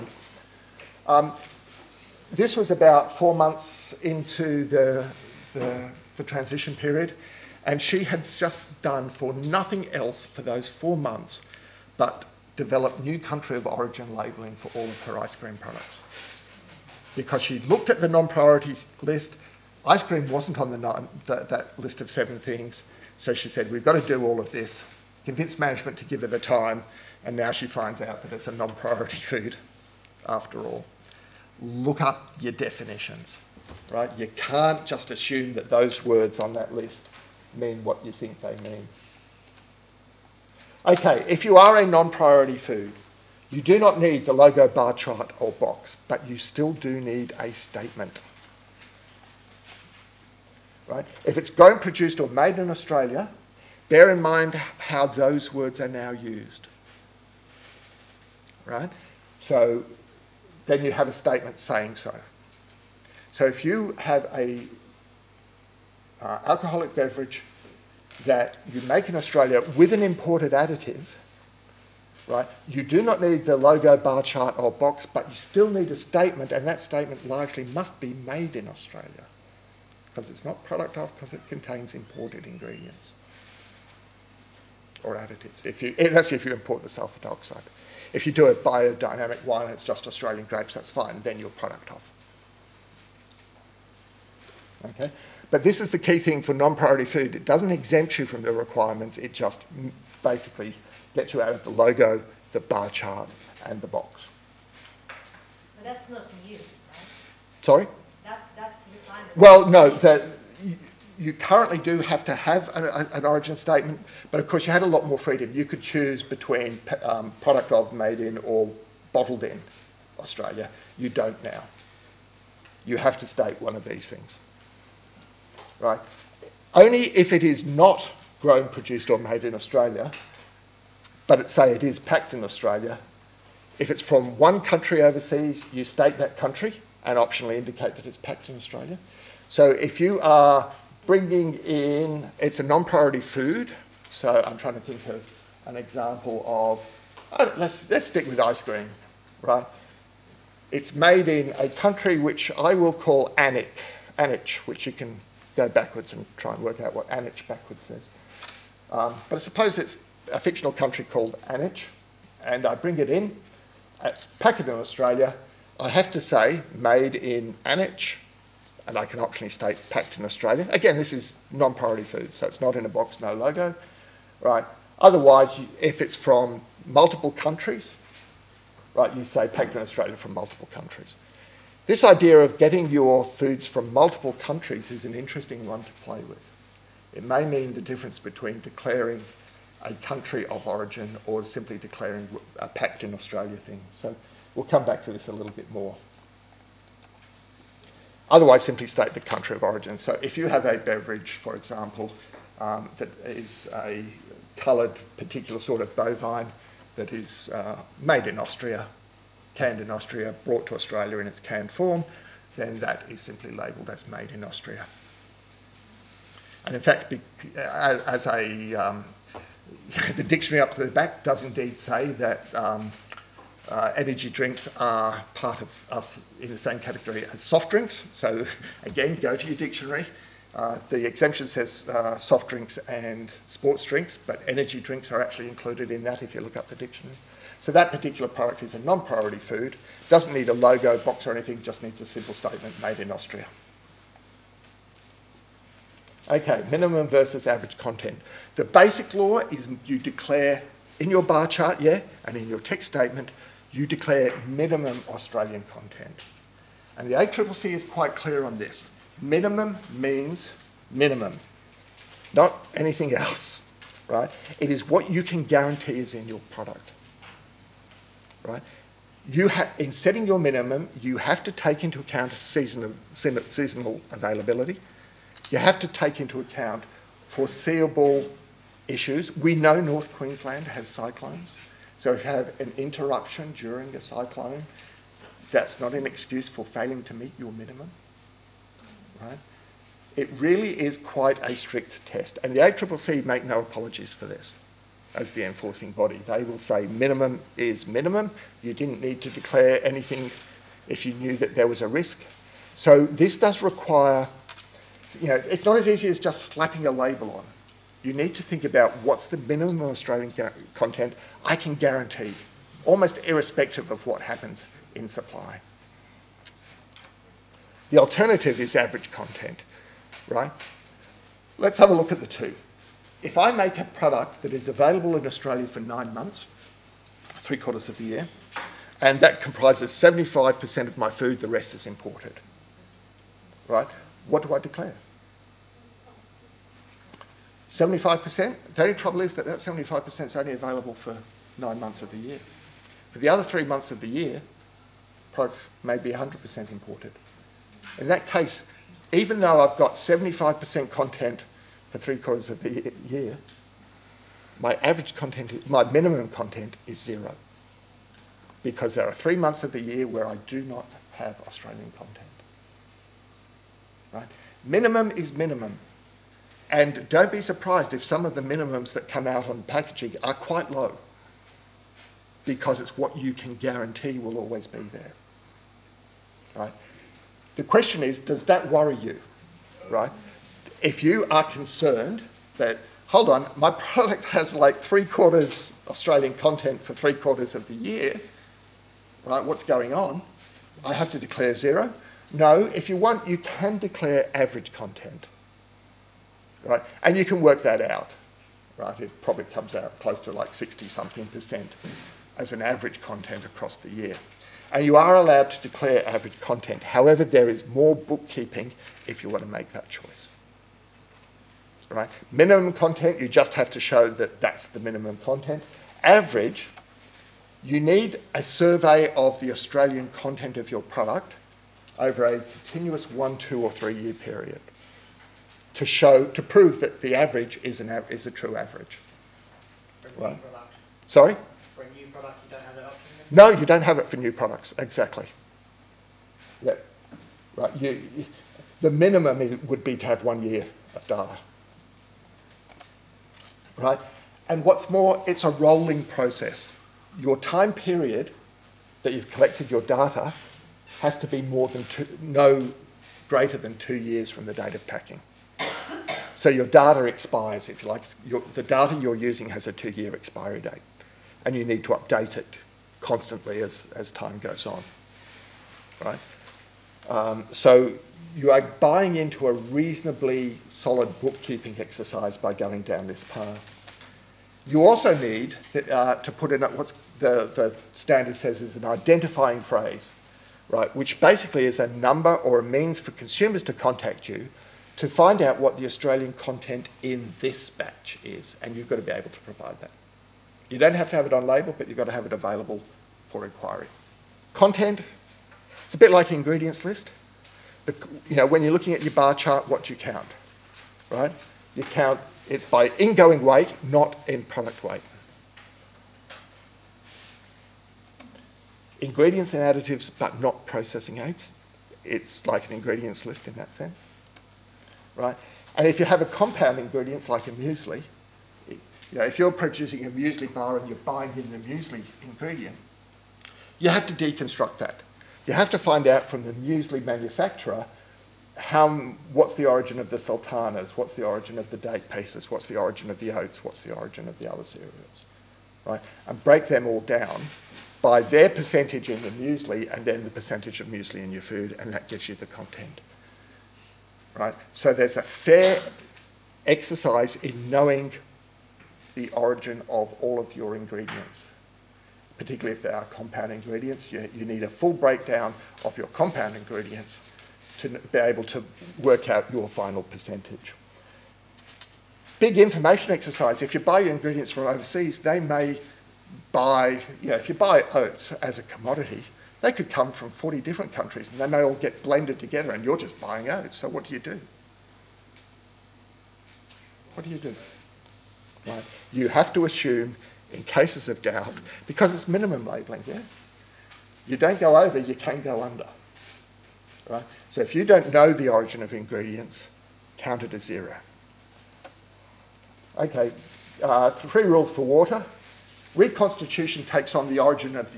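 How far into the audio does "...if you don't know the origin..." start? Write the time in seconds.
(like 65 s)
587 s.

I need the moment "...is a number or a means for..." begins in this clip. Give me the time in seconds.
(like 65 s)
481 s.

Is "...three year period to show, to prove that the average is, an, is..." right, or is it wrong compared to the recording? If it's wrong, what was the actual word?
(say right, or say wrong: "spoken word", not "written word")
right.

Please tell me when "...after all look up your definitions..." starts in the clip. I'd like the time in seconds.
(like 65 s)
30 s.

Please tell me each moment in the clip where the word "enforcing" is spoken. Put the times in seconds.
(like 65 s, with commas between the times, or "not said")
295 s.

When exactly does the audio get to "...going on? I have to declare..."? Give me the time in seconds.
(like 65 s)
389 s.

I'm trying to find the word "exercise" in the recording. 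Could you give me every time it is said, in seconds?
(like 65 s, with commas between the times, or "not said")
471 s, 546 s, 563 s.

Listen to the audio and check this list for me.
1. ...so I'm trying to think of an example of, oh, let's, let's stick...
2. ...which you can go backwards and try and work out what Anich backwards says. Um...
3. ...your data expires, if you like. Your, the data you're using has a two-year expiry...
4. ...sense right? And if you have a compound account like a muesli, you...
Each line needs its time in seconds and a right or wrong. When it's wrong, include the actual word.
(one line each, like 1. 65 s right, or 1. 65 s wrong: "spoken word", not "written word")
1. 144 s right
2. 154 s right
3. 456 s right
4. 513 s wrong: "ingredient", not "account".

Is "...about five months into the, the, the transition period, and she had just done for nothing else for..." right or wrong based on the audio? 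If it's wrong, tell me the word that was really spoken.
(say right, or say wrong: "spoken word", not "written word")
wrong: "four", not "five".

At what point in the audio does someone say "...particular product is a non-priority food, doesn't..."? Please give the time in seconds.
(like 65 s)
237 s.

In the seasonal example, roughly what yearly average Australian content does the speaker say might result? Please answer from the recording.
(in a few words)
60 something percent.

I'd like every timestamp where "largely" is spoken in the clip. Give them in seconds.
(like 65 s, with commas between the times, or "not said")
77 s.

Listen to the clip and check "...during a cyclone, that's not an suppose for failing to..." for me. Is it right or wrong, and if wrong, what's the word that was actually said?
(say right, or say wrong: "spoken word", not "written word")
wrong: "excuse", not "suppose".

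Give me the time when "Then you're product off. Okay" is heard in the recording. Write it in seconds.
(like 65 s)
91 s.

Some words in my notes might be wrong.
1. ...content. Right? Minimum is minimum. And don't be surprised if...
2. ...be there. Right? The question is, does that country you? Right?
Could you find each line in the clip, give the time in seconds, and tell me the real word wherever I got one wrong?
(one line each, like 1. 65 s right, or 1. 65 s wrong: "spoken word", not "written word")
1. 361 s right
2. 374 s wrong: "worry", not "country".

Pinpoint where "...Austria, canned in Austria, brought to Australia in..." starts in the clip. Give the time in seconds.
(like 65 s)
208 s.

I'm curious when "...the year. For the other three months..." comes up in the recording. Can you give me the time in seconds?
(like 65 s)
342 s.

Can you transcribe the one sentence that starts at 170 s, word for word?
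Again, this is non-priority food, so it's not in a box, no logo.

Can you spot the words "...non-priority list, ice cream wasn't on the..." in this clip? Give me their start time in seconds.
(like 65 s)
18 s.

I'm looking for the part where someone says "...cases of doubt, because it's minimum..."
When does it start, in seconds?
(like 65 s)
580 s.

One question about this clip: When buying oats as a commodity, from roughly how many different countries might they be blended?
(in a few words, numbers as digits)
40.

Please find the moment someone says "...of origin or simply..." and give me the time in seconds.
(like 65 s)
190 s.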